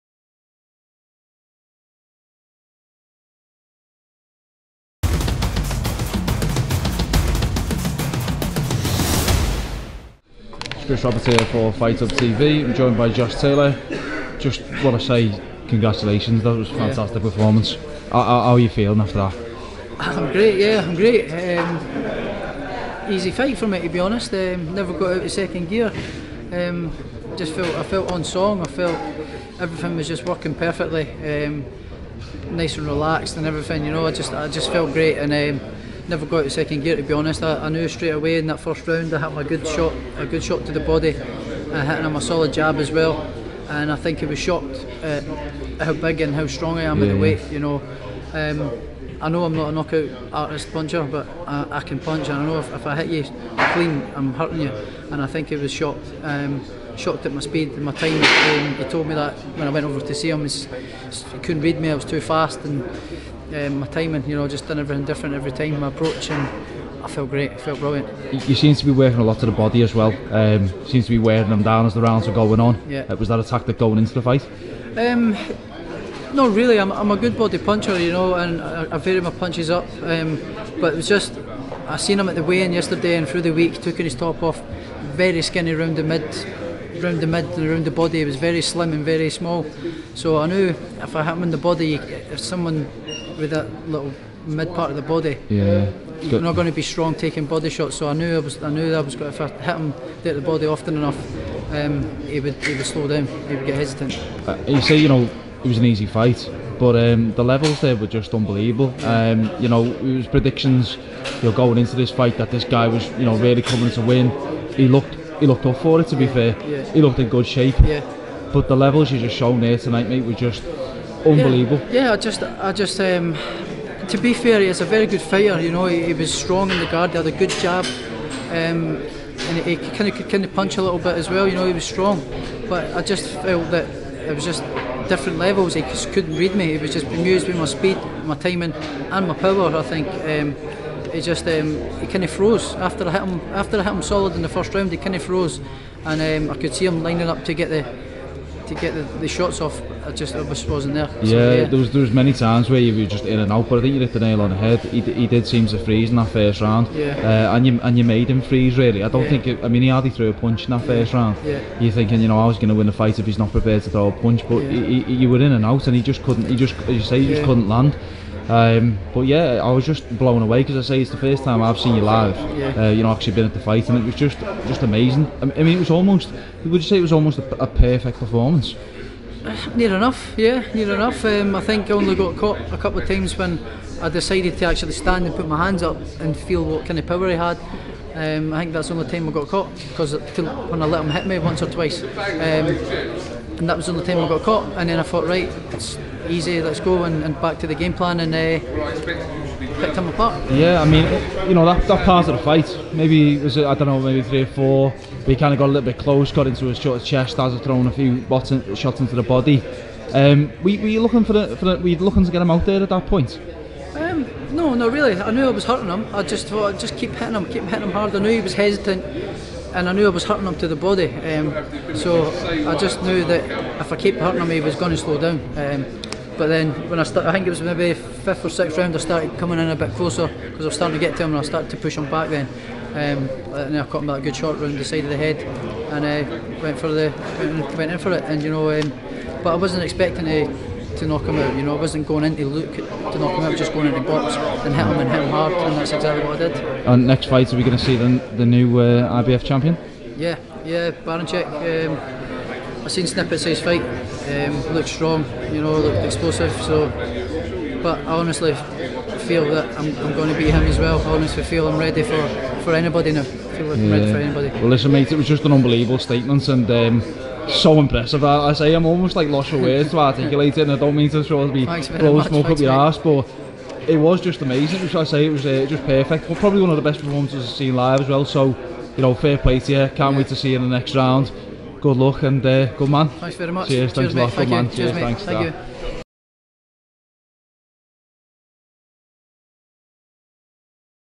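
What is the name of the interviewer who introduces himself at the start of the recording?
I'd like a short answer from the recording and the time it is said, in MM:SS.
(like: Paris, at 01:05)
Chris Roberts, at 00:10.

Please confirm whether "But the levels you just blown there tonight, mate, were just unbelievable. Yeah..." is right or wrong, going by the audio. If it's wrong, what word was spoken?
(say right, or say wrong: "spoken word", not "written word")
wrong: "shown", not "blown".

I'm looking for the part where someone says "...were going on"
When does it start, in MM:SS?
01:12.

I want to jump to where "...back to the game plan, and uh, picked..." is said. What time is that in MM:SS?
03:17.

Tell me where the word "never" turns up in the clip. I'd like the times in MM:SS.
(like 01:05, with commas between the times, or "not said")
00:24, 00:36.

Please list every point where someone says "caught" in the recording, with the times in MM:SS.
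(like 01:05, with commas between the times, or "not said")
03:02, 03:09, 03:14, 03:53.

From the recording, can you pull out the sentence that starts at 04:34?
Which I say it was uh, just perfect.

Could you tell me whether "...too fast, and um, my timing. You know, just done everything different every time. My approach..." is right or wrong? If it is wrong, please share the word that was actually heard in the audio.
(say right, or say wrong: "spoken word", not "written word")
right.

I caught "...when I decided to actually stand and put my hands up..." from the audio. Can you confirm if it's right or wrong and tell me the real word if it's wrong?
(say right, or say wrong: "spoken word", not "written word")
right.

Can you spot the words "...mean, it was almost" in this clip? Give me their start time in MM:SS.
02:55.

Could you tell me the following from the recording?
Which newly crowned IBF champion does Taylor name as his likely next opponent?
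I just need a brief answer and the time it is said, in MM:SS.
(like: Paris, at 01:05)
Baranchyk, at 04:10.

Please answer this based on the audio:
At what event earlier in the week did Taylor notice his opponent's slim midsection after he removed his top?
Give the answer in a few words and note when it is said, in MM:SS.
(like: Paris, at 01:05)
The weigh-in, at 01:22.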